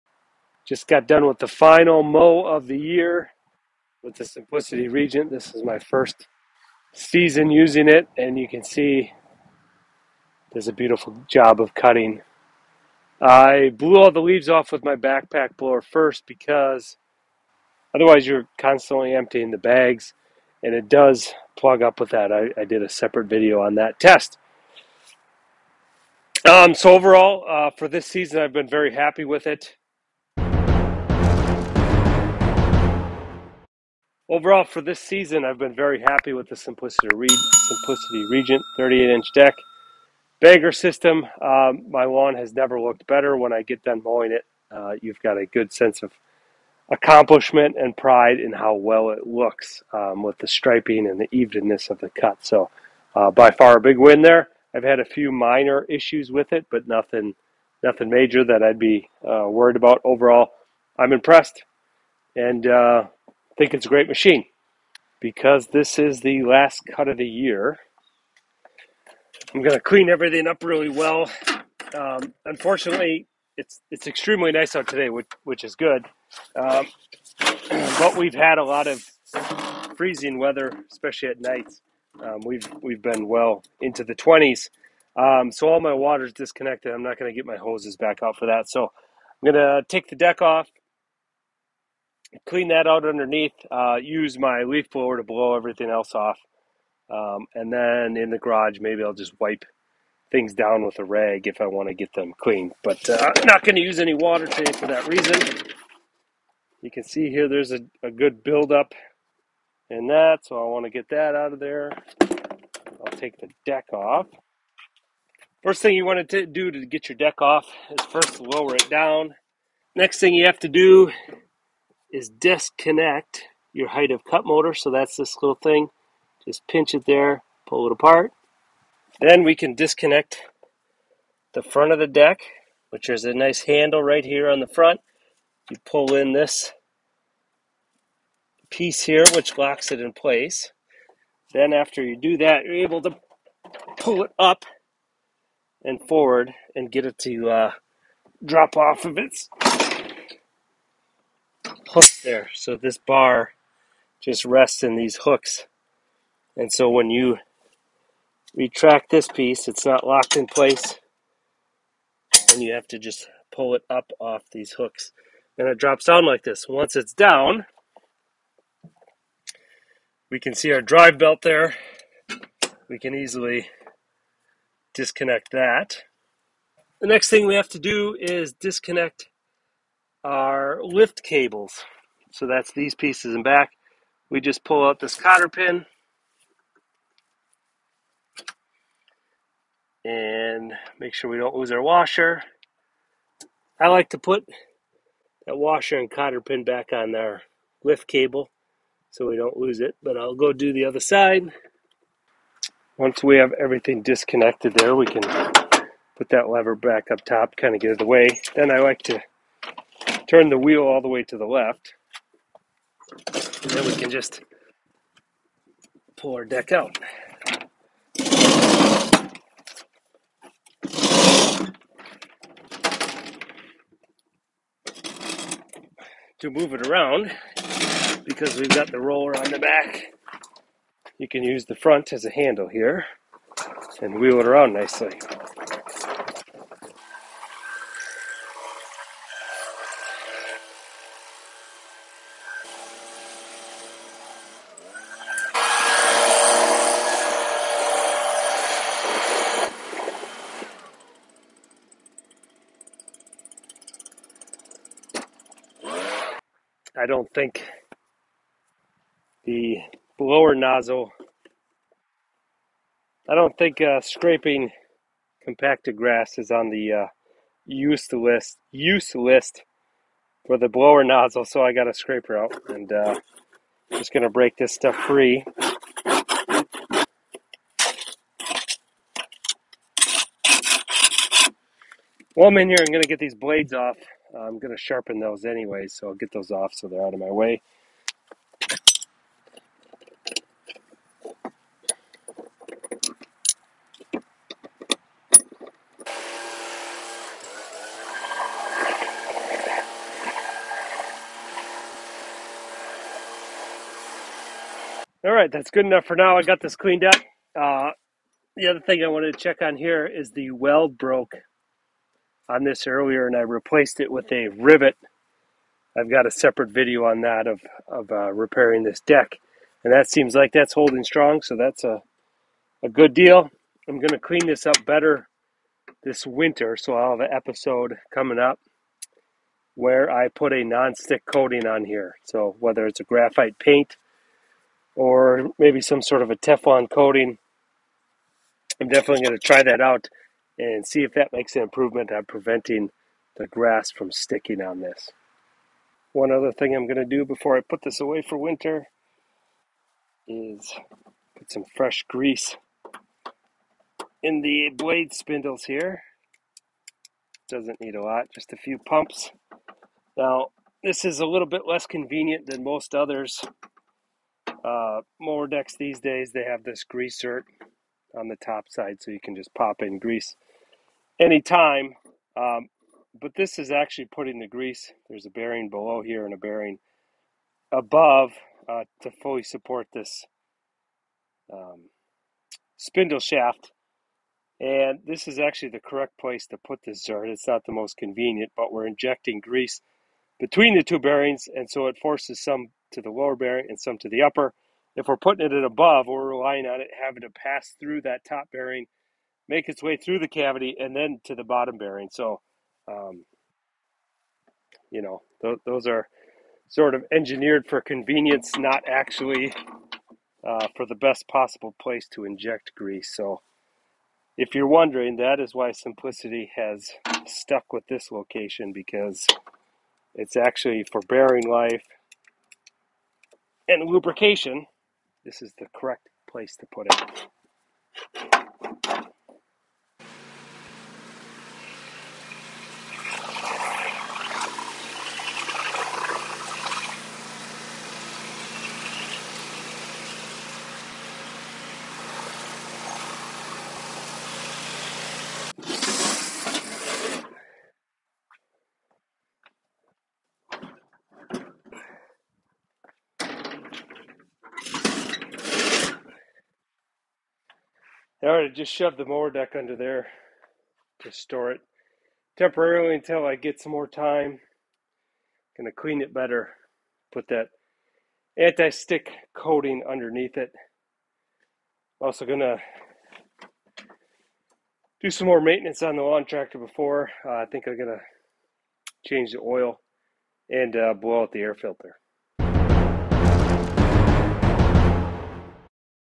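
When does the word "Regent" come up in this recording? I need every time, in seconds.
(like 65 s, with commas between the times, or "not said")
4 s, 38 s.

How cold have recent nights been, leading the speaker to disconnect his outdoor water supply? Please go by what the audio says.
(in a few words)
the 20s.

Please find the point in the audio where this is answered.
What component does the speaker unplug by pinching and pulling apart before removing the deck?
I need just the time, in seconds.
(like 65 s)
123 s.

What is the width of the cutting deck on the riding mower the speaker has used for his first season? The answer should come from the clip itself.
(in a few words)
38-inch.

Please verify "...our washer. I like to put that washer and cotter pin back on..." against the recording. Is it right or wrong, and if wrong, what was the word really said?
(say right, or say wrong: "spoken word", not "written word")
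right.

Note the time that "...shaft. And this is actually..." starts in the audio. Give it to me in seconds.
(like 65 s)
383 s.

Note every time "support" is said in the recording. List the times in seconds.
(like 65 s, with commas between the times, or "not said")
379 s.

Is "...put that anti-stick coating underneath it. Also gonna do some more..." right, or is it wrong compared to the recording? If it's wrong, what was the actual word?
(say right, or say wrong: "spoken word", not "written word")
right.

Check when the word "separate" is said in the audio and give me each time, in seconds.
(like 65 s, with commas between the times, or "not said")
22 s, 316 s.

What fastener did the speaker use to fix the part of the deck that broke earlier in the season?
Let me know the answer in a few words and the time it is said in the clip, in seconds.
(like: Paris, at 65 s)
rivet, at 314 s.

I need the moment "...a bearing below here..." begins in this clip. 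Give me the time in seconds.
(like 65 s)
375 s.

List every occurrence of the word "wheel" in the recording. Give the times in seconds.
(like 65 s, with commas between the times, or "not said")
210 s, 234 s.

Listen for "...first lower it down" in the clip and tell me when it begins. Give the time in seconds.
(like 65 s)
118 s.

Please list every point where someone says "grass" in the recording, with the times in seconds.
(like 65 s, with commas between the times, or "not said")
265 s, 343 s.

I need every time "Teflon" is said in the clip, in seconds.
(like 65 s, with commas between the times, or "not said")
336 s.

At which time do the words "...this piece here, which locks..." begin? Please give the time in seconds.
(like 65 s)
136 s.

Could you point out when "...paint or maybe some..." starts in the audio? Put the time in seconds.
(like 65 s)
333 s.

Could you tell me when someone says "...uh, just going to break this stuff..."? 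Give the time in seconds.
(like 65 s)
272 s.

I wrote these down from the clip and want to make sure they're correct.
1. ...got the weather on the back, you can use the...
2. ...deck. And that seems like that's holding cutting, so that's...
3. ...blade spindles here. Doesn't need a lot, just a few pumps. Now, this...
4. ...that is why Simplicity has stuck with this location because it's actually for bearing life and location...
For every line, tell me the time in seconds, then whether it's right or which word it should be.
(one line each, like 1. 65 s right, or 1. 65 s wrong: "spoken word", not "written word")
1. 228 s wrong: "roller", not "weather"
2. 319 s wrong: "strong", not "cutting"
3. 354 s right
4. 415 s wrong: "lubrication", not "location".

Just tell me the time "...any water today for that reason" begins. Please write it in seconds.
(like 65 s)
103 s.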